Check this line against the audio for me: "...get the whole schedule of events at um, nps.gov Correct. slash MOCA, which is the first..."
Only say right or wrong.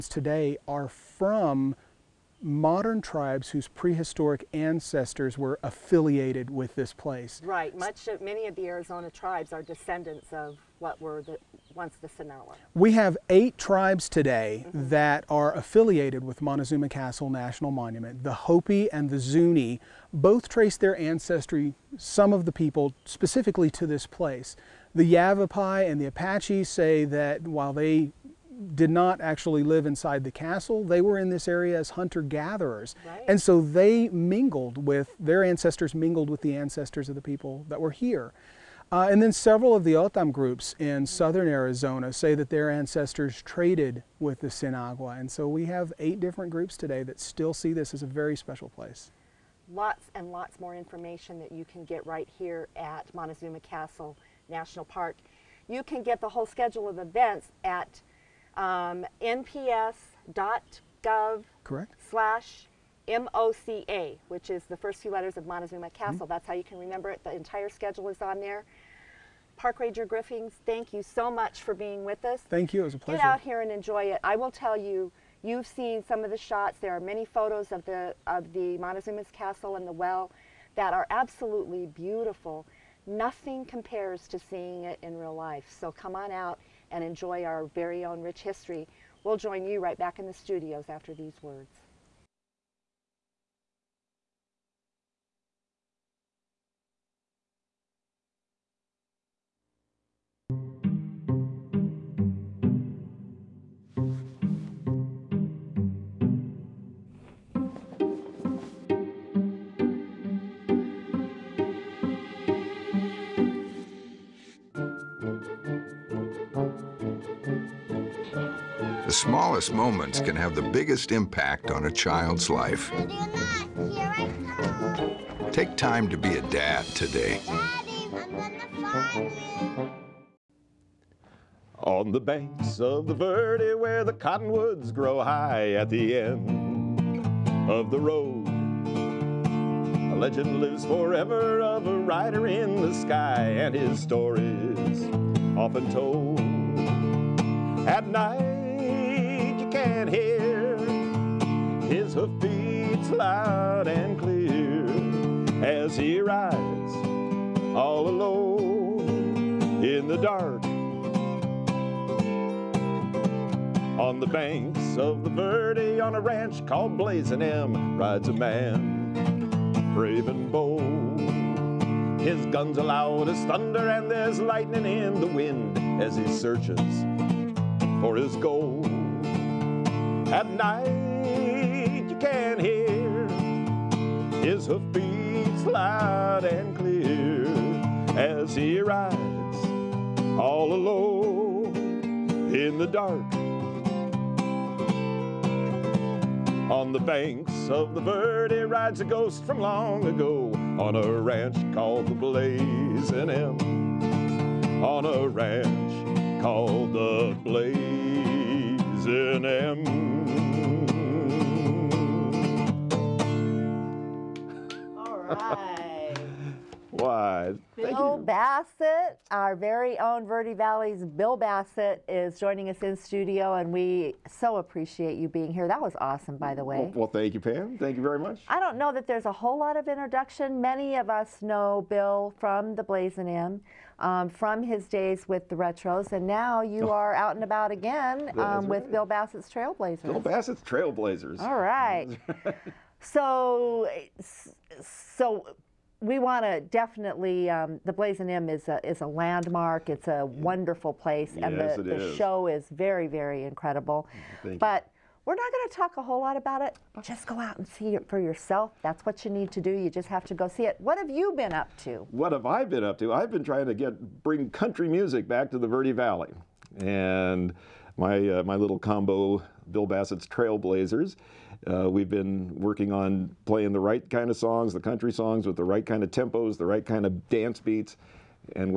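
right.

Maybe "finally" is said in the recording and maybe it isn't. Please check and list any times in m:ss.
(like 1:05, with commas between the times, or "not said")
not said.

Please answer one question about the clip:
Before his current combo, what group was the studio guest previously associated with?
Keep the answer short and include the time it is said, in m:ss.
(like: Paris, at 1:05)
The Retros, at 3:55.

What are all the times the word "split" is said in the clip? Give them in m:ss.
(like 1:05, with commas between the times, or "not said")
not said.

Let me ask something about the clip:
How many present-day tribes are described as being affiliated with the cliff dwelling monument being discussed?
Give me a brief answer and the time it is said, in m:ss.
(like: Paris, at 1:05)
8, at 0:13.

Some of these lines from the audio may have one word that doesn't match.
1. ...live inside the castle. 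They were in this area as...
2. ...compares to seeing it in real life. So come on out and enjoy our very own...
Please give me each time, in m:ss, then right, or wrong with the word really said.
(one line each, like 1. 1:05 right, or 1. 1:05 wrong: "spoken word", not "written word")
1. 0:29 right
2. 1:23 right.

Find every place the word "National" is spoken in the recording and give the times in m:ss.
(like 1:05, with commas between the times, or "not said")
0:17, 0:54.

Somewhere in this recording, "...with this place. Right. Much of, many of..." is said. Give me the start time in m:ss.
0:06.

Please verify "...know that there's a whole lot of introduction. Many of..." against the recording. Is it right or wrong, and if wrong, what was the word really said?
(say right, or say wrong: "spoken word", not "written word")
right.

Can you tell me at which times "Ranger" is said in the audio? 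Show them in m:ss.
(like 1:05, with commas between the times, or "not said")
1:09.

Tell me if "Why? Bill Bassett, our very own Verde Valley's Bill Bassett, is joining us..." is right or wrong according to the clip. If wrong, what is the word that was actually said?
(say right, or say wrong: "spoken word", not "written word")
right.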